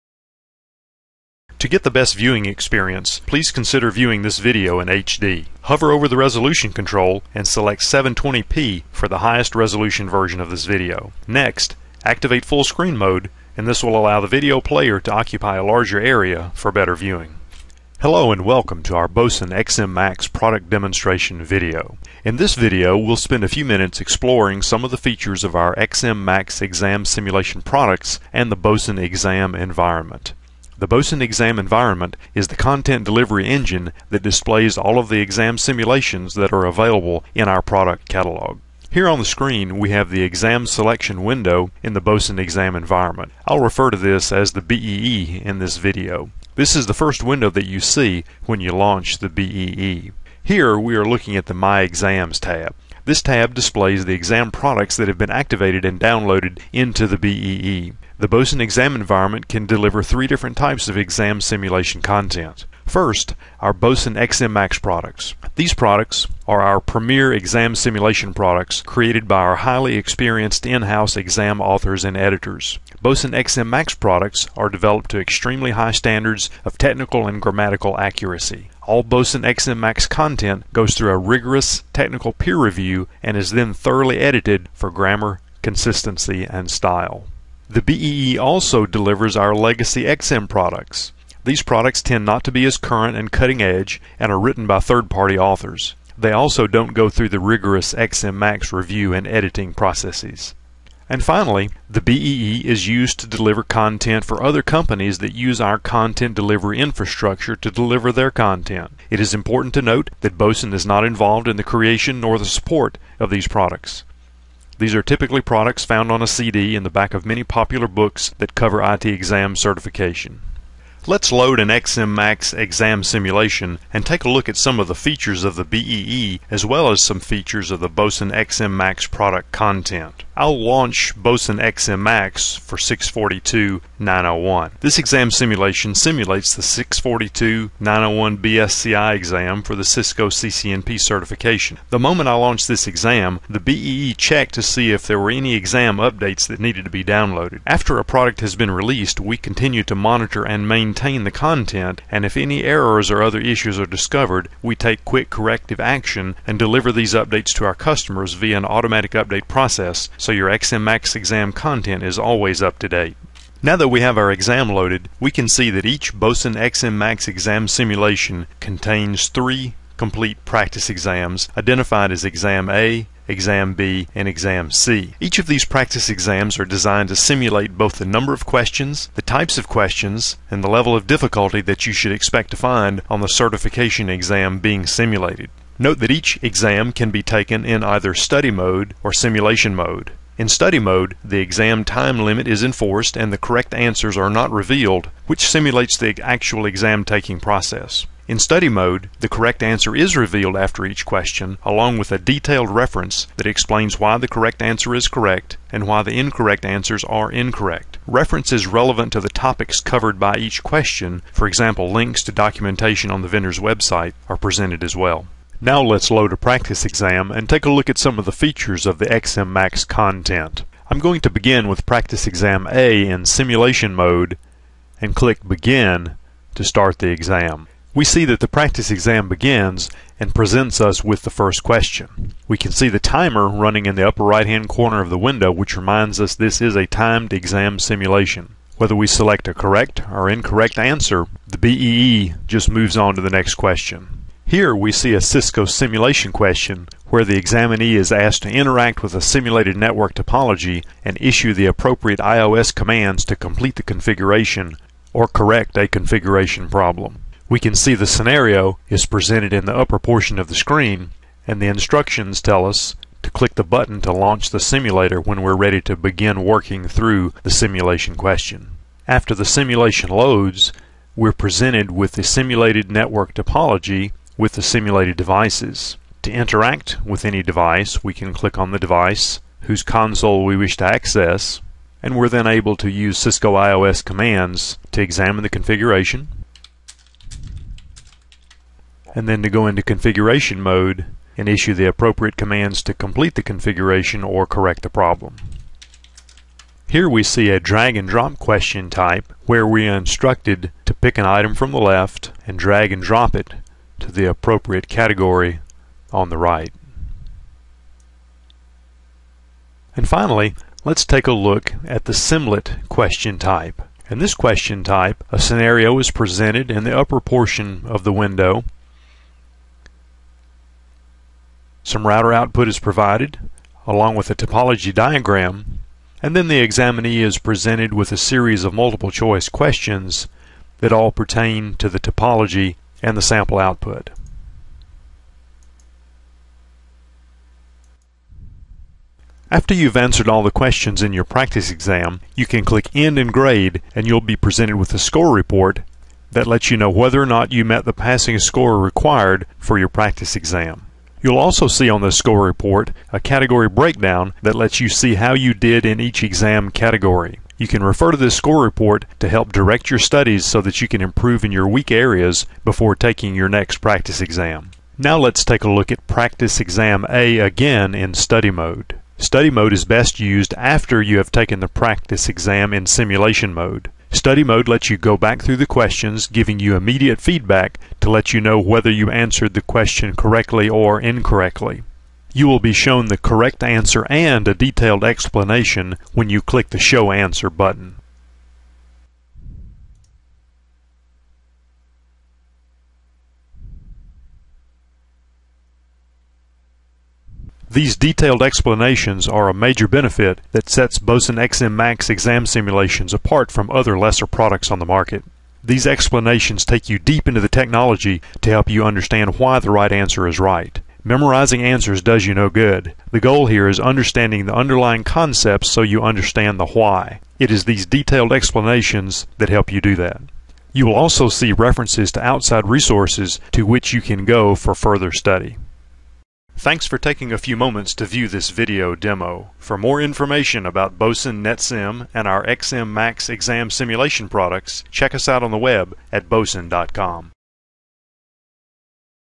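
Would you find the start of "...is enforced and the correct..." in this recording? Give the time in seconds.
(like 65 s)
192 s.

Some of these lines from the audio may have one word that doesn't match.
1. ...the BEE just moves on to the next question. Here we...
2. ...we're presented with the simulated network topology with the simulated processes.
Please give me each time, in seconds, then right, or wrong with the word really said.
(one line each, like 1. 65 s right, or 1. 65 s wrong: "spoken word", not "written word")
1. 241 s right
2. 271 s wrong: "devices", not "processes".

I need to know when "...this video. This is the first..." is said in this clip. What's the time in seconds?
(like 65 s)
45 s.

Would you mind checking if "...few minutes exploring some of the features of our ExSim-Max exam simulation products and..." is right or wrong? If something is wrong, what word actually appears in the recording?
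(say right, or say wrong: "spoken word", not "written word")
right.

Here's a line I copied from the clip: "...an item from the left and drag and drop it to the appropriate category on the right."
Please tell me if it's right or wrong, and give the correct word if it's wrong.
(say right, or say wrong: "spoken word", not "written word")
right.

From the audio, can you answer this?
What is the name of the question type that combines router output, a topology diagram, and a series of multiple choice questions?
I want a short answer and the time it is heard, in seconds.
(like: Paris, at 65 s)
Simlet, at 312 s.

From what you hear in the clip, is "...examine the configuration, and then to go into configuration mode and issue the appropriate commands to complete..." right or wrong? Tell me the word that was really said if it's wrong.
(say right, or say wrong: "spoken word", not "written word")
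right.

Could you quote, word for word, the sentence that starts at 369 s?
Study mode is best used after you have taken the practice exam in simulation mode.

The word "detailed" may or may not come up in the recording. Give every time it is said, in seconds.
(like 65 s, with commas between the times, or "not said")
202 s, 384 s, 397 s, 417 s.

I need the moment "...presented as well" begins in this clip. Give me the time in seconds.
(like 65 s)
214 s.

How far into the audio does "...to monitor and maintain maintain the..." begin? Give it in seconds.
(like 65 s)
149 s.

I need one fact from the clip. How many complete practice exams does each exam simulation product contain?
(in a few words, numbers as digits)
3.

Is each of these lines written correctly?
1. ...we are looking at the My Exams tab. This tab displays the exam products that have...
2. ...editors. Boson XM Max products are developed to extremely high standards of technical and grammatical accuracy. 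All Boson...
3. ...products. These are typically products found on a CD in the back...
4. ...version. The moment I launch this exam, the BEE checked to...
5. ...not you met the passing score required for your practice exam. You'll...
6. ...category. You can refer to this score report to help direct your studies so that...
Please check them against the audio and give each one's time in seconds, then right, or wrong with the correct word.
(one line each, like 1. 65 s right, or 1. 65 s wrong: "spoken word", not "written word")
1. 50 s right
2. 72 s right
3. 113 s right
4. 140 s wrong: "certification", not "version"
5. 347 s right
6. 356 s right.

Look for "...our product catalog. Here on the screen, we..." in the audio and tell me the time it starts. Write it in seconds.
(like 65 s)
37 s.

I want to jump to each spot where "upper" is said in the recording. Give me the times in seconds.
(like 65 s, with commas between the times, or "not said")
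234 s, 259 s, 316 s.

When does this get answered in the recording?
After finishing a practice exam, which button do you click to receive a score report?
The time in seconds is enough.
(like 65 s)
342 s.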